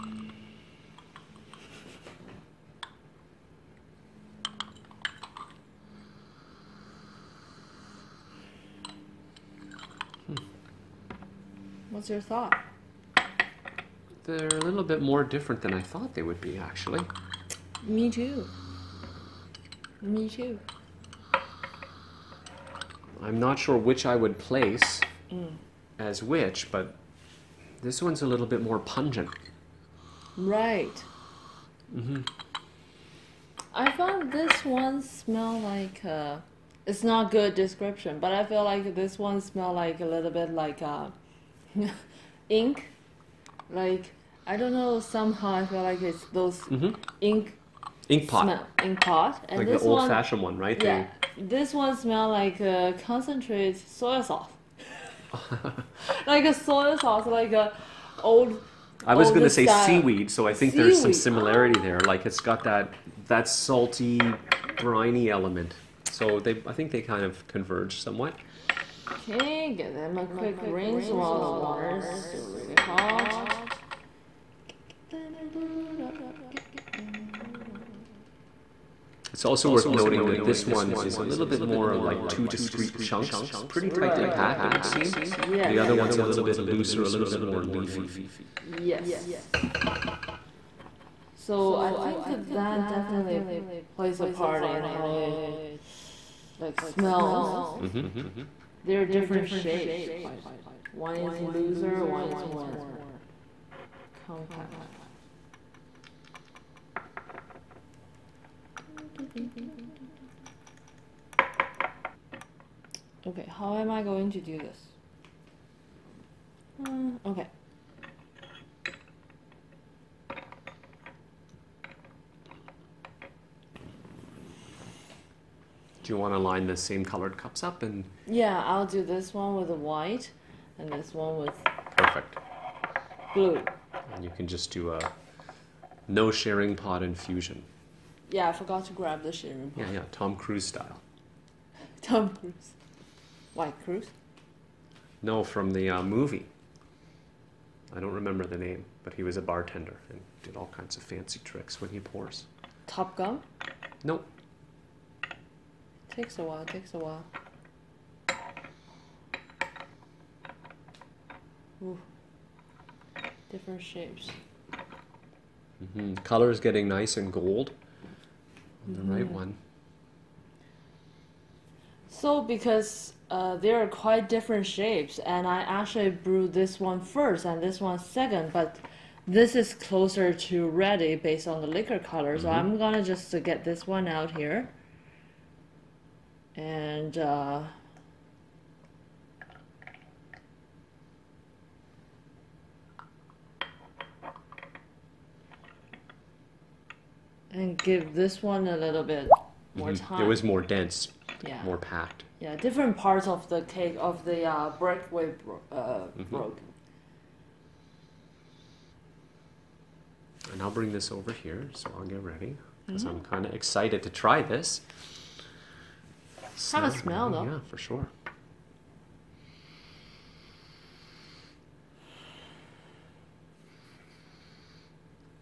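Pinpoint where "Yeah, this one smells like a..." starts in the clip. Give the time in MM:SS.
00:50.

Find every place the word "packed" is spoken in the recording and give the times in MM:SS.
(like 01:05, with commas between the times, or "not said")
01:24, 03:21.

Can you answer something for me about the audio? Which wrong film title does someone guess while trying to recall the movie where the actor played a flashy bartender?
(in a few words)
Top Gun.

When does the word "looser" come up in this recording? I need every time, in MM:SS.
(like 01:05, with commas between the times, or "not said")
01:26, 01:41.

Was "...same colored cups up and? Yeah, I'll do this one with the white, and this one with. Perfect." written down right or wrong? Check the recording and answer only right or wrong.
right.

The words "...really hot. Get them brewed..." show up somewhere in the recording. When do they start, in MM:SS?
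01:12.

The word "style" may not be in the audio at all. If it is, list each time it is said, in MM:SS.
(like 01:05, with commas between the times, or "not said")
00:59, 02:20.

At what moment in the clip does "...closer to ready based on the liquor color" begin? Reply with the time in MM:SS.
02:59.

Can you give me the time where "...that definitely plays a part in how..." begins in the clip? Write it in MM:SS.
01:32.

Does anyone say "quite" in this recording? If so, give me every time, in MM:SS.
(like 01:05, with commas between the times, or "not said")
01:40, 02:53.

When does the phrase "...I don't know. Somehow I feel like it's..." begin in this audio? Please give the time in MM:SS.
00:44.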